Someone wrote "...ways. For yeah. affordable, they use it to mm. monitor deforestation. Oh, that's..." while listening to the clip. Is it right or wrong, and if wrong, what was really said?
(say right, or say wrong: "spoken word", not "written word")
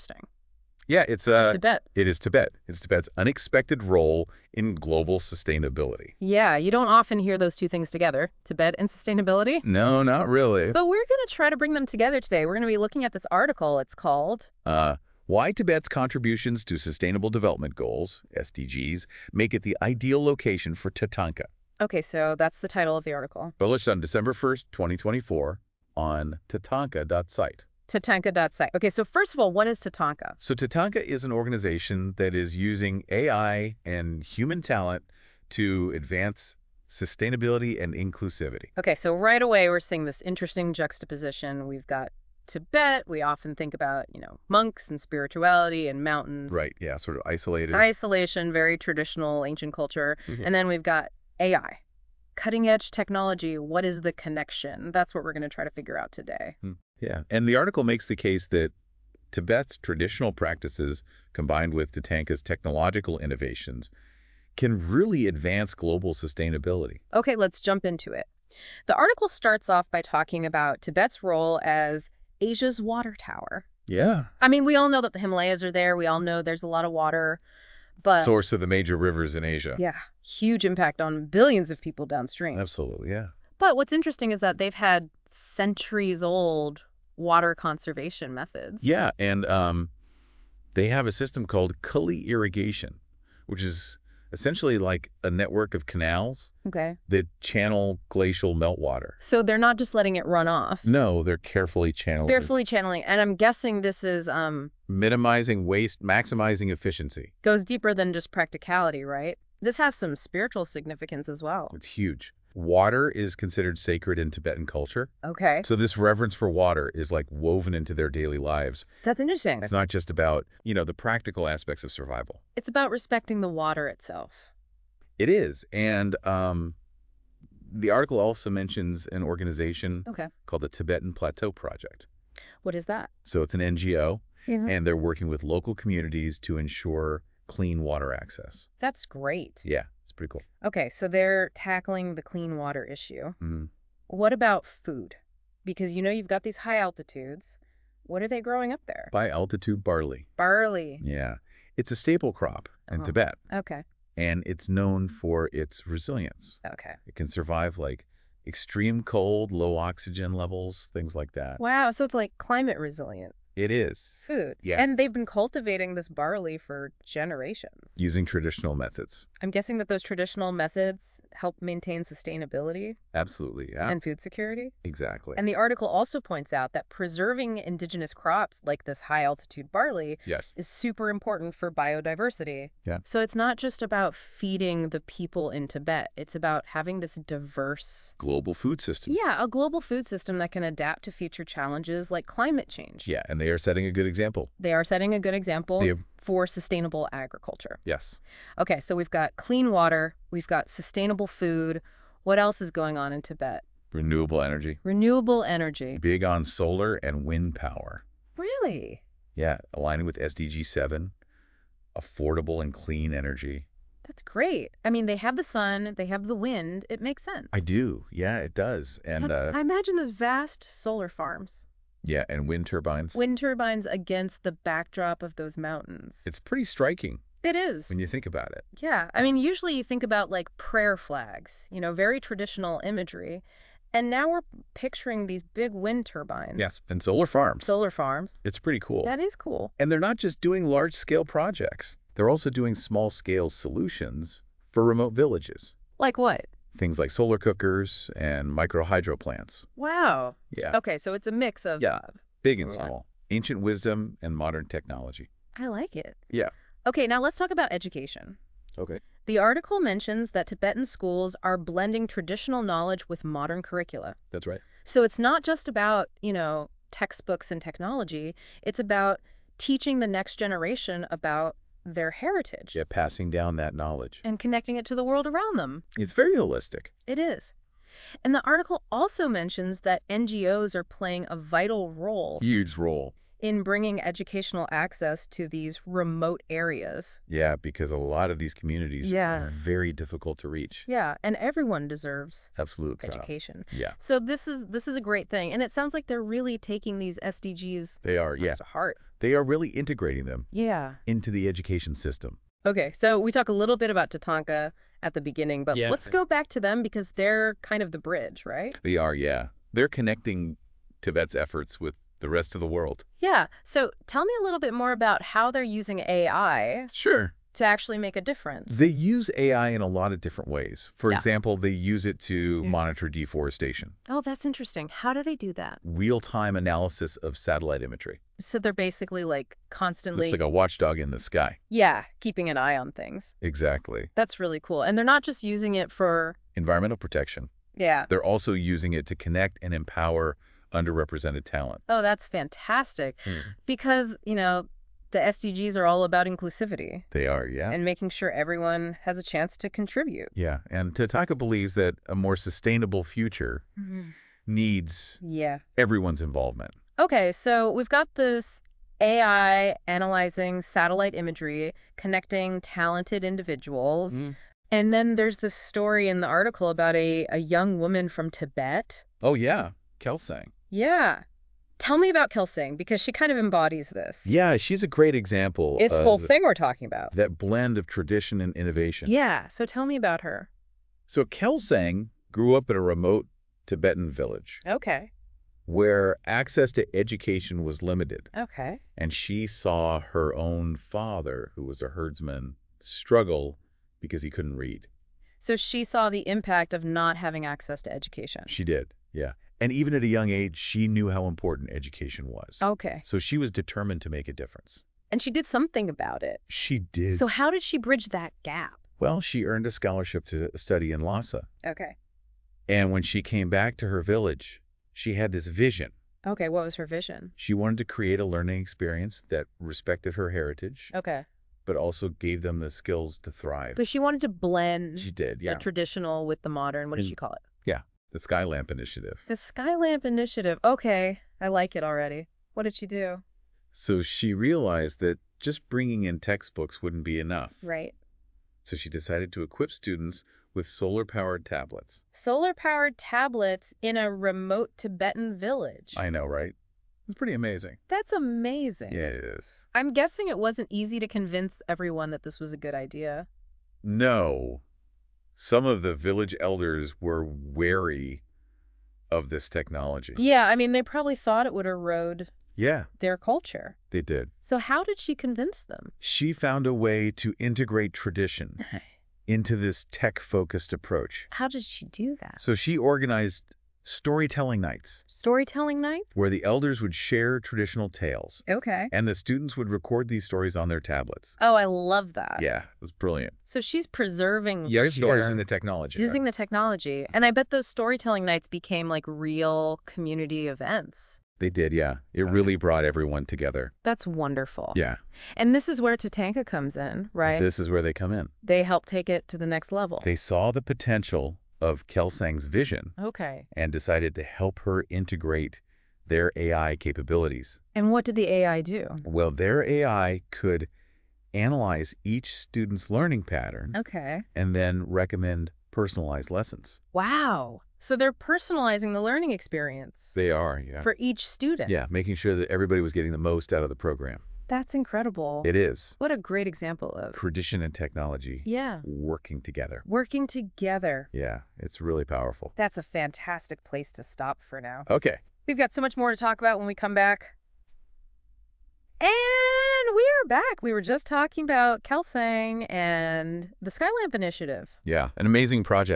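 wrong: "example", not "affordable".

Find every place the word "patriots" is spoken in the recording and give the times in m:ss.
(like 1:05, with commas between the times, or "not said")
not said.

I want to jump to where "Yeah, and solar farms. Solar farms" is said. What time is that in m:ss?
3:56.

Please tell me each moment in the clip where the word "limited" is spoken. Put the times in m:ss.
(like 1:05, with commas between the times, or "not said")
6:27.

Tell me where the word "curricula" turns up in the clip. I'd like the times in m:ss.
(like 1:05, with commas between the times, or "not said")
4:23.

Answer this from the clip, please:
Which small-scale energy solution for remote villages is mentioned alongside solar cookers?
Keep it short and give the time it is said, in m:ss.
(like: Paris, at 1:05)
micro hydro plants, at 4:08.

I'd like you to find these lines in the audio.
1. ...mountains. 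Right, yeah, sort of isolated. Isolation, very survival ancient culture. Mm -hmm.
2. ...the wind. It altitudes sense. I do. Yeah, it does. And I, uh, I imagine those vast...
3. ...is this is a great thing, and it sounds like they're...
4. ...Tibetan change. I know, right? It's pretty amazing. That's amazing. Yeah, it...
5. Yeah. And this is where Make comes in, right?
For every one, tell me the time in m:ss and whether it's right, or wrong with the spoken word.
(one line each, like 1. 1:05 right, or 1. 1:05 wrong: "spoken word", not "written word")
1. 0:46 wrong: "traditional", not "survival"
2. 3:36 wrong: "makes", not "altitudes"
3. 4:54 right
4. 7:24 wrong: "village", not "change"
5. 8:14 wrong: "Tatanka", not "Make".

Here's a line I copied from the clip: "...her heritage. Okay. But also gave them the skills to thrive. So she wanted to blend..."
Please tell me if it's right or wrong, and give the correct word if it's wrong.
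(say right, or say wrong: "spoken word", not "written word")
right.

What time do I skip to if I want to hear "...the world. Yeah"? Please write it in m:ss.
5:12.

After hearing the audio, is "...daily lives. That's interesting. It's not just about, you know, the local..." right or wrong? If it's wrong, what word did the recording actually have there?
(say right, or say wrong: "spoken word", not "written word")
wrong: "practical", not "local".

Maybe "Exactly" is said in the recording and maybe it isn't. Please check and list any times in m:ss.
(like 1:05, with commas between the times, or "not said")
2:54, 5:33.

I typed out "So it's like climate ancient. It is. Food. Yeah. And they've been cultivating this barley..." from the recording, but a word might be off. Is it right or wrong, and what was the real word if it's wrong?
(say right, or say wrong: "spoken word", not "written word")
wrong: "resilient", not "ancient".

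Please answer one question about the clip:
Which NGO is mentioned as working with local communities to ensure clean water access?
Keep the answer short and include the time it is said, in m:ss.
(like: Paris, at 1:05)
Tibetan Plateau Project, at 2:10.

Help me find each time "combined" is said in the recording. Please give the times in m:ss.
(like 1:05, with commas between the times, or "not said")
1:01.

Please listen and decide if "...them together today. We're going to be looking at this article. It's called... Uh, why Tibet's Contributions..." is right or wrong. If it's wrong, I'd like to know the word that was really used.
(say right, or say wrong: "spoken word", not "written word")
right.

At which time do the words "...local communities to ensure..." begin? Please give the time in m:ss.
2:15.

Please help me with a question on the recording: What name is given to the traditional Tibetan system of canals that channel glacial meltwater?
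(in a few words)
cully irrigation.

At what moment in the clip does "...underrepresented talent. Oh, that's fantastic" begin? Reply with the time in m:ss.
5:40.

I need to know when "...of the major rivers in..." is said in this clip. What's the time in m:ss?
1:18.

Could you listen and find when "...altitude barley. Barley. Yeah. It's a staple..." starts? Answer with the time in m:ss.
2:29.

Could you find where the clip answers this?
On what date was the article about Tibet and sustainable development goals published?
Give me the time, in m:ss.
0:23.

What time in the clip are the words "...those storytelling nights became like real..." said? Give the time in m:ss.
8:07.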